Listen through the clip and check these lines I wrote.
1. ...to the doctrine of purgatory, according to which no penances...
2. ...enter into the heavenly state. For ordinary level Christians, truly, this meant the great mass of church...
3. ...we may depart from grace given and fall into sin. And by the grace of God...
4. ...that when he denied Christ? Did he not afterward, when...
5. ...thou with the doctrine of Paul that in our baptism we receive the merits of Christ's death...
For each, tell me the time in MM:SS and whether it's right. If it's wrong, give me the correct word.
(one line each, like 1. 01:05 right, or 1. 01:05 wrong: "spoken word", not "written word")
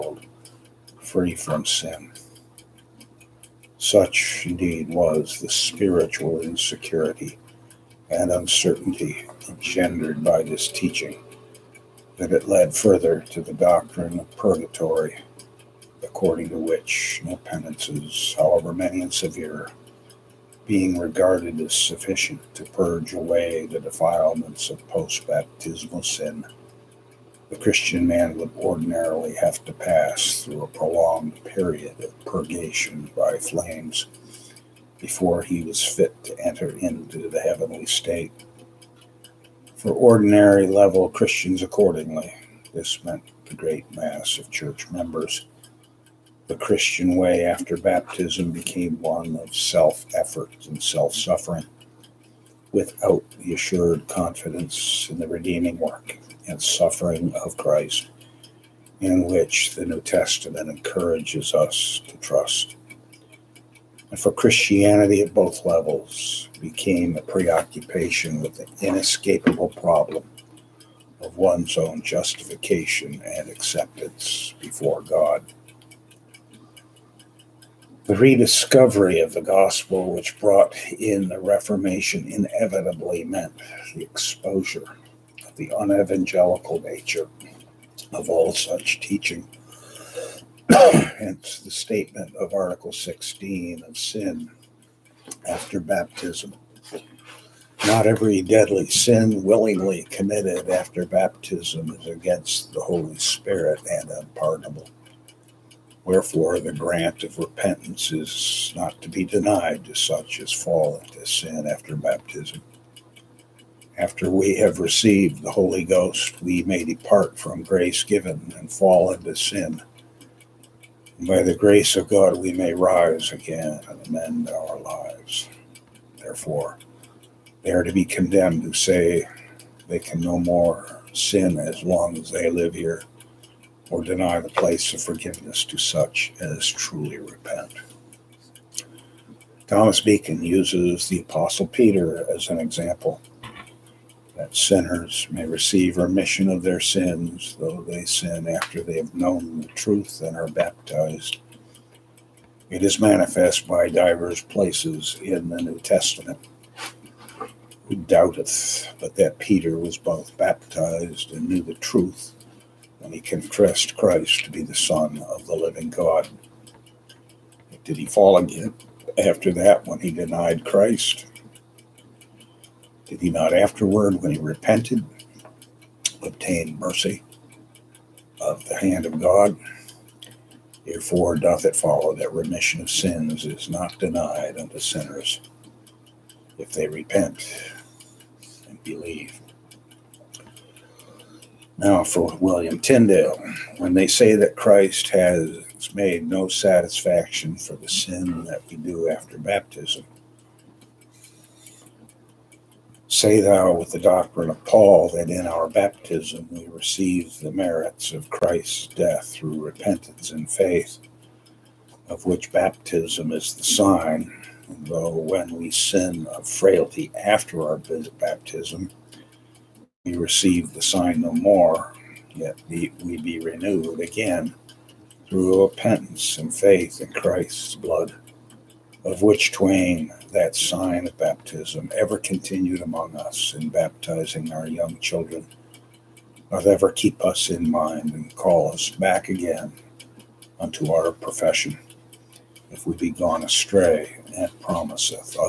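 1. 00:13 right
2. 00:36 wrong: "accordingly", not "truly"
3. 01:56 right
4. 02:49 right
5. 03:23 right.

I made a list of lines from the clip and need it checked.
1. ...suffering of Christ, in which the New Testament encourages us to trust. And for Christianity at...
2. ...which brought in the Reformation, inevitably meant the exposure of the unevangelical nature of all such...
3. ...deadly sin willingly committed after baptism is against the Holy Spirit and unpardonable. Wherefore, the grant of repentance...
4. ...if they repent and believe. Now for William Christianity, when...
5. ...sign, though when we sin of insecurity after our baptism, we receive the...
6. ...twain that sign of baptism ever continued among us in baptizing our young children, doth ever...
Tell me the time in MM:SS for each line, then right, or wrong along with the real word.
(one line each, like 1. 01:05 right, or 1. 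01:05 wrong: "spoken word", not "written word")
1. 00:56 right
2. 01:20 right
3. 01:38 right
4. 03:06 wrong: "Tyndale", not "Christianity"
5. 03:33 wrong: "frailty", not "insecurity"
6. 03:49 right.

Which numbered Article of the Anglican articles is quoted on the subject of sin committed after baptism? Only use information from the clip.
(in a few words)
Article 16.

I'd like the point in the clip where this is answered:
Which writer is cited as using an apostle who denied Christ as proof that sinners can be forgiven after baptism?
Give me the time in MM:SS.
02:19.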